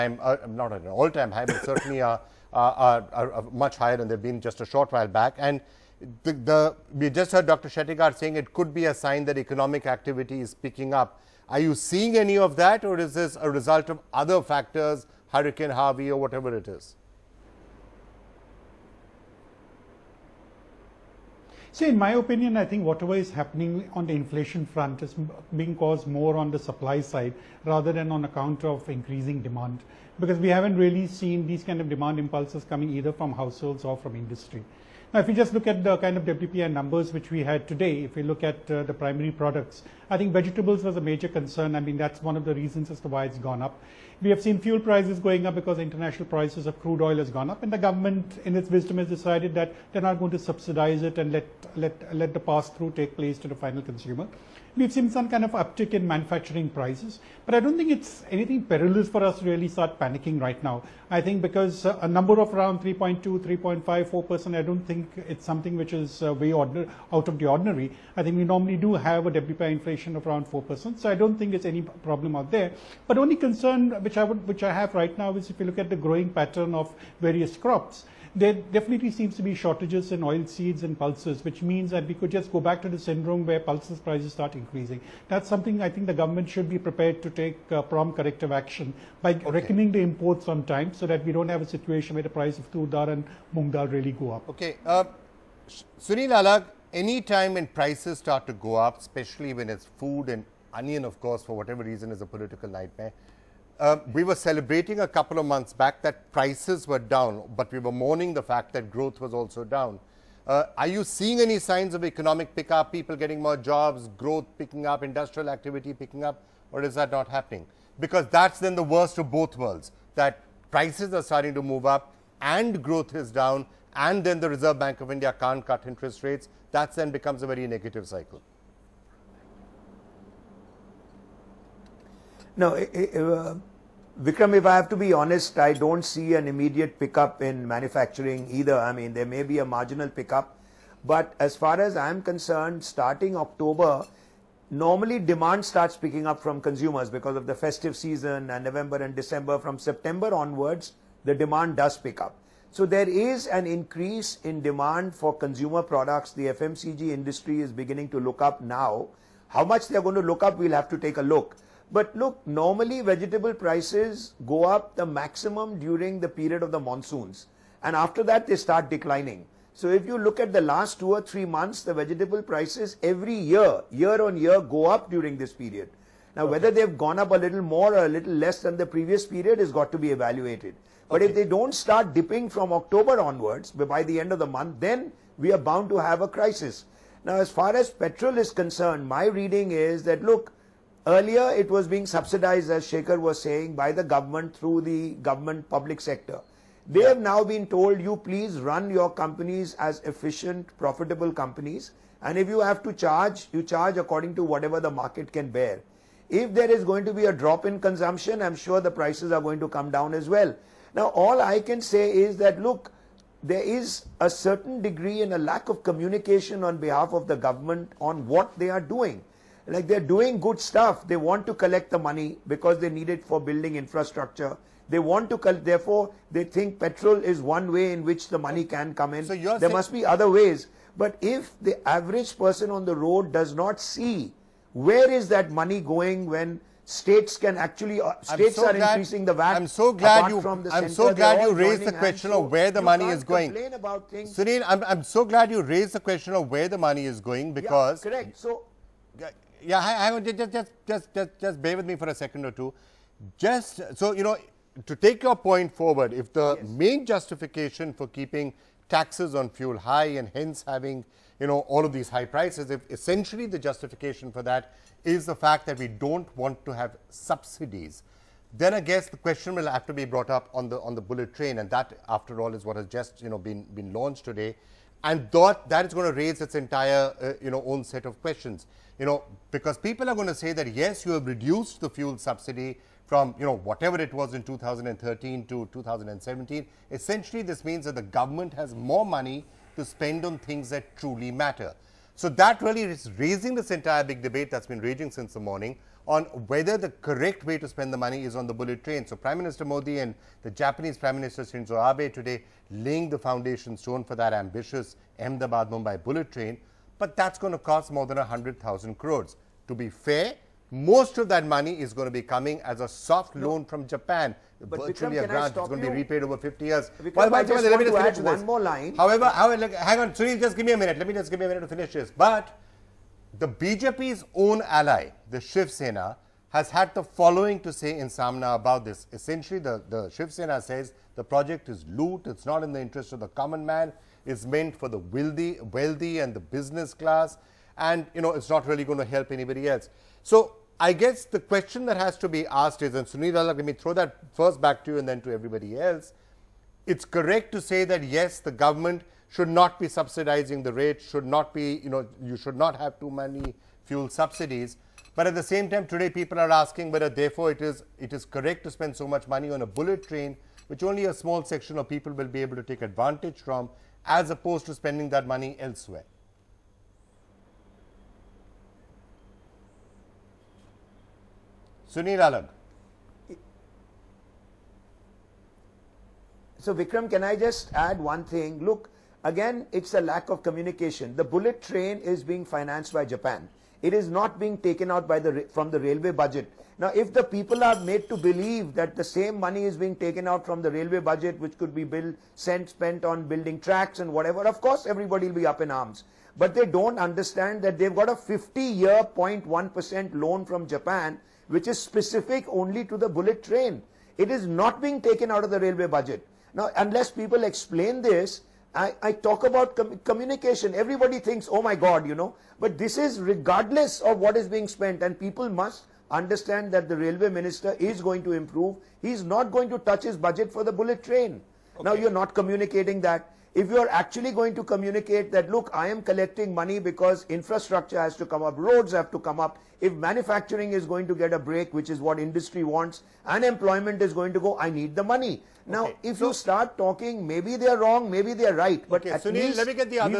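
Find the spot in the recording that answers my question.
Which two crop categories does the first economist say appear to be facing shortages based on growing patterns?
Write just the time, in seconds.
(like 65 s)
80 s.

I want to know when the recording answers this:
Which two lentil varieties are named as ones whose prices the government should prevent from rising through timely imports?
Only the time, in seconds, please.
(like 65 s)
92 s.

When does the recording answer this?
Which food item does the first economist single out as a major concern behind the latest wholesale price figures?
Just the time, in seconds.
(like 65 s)
40 s.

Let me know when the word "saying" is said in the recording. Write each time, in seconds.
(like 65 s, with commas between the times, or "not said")
8 s, 193 s.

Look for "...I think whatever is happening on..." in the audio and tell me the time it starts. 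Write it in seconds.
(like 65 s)
22 s.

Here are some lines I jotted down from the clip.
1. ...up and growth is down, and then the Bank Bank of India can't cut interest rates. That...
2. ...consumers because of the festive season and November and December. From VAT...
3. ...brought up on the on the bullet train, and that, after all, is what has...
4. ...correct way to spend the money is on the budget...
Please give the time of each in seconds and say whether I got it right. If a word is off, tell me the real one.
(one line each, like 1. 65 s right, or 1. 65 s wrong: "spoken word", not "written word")
1. 121 s wrong: "Reserve", not "Bank"
2. 146 s wrong: "September", not "VAT"
3. 270 s right
4. 296 s wrong: "bullet", not "budget".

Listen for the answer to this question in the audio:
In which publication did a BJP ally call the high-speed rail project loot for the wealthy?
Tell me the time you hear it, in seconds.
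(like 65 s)
328 s.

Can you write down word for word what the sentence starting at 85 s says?
That's something I think the government should be prepared to take uh, prompt corrective action by okay.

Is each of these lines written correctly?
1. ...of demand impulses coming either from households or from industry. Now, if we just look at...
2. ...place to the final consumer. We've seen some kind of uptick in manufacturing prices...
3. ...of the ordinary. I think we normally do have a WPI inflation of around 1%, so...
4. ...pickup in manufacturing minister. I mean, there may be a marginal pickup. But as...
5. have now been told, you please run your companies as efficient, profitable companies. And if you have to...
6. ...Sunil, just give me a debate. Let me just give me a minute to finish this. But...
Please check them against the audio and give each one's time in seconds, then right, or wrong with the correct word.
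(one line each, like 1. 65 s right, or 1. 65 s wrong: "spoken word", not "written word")
1. 31 s right
2. 53 s right
3. 67 s wrong: "4", not "1"
4. 136 s wrong: "either", not "minister"
5. 197 s right
6. 320 s wrong: "minute", not "debate".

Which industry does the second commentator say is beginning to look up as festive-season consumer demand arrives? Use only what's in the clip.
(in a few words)
FMCG.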